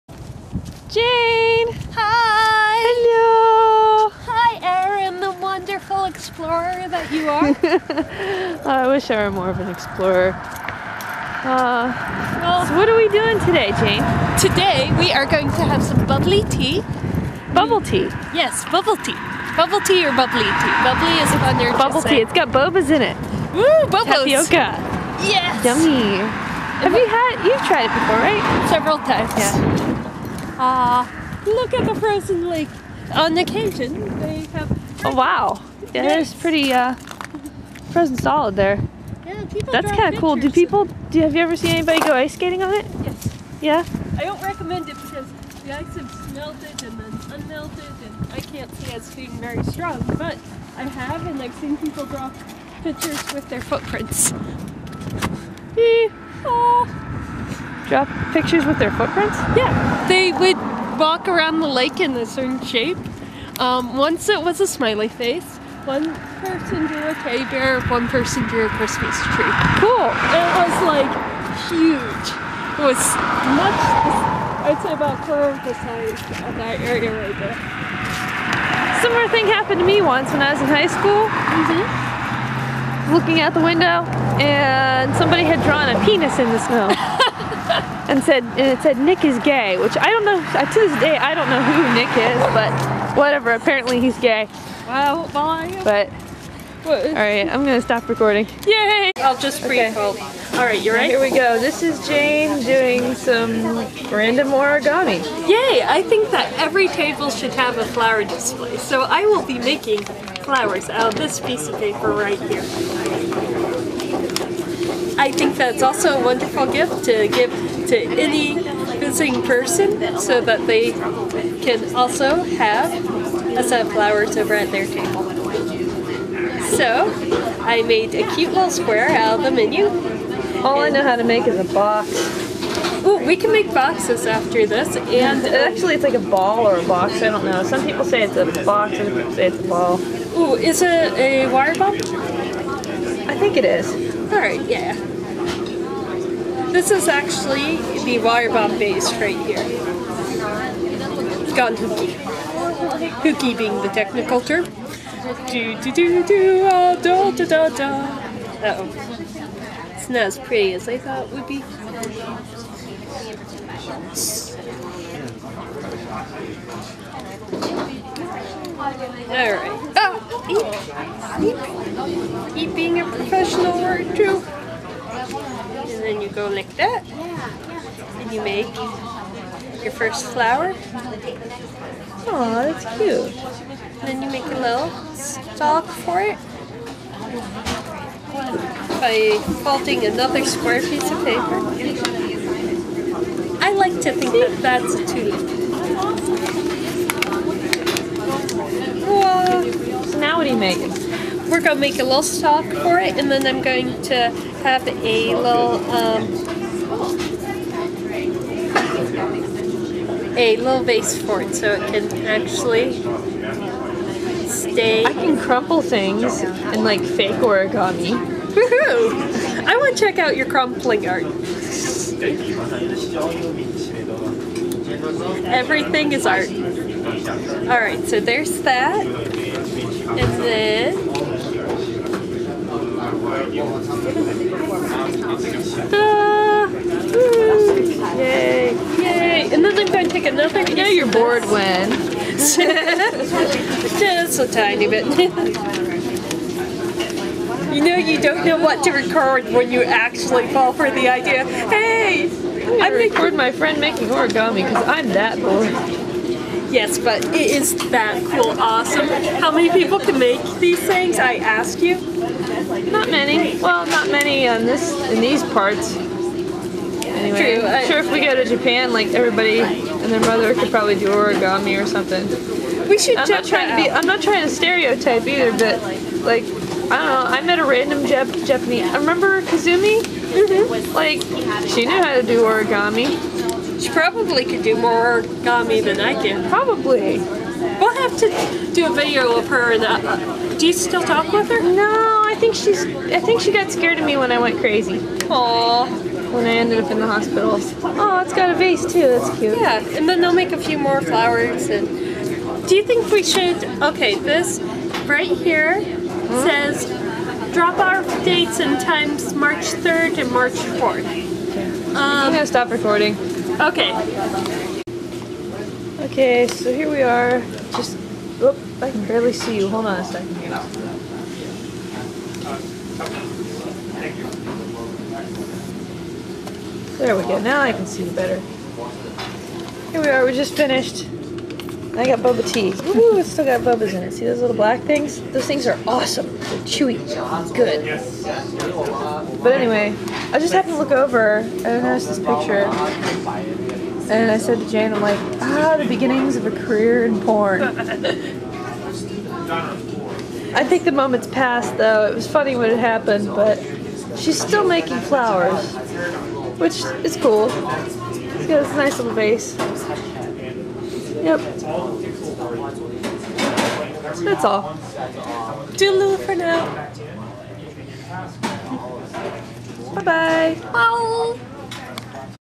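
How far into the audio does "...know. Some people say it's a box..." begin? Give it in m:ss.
2:17.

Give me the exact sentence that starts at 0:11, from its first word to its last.
Uh, well, so what are we doing today, Jane?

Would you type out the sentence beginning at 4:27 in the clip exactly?
I'm sure if we go to Japan, like everybody and their mother could probably do origami or something.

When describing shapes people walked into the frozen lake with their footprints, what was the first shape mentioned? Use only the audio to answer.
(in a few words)
smiley face.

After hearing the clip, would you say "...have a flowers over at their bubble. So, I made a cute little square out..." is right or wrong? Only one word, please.
wrong.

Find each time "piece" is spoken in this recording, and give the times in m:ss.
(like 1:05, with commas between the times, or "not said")
1:51, 3:10.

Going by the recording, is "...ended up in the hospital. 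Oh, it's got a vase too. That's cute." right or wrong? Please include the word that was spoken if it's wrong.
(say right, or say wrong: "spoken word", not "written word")
right.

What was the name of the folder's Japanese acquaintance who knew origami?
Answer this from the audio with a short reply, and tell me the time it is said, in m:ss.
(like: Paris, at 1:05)
Kazumi, at 4:39.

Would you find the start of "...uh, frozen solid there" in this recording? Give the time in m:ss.
0:36.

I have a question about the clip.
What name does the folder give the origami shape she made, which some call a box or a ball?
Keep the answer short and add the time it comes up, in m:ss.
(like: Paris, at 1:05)
water bomb base, at 2:28.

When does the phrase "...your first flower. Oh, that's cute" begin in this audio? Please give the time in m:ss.
2:59.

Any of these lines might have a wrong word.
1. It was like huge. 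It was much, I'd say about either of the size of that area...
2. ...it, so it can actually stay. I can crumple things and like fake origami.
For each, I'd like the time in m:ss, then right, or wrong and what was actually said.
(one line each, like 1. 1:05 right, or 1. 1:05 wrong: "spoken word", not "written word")
1. 1:10 wrong: "quarter", not "either"
2. 3:31 right.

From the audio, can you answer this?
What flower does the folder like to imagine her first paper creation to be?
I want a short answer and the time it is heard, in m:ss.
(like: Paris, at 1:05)
tulip, at 3:15.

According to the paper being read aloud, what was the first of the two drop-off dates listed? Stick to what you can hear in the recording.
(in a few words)
March 3rd.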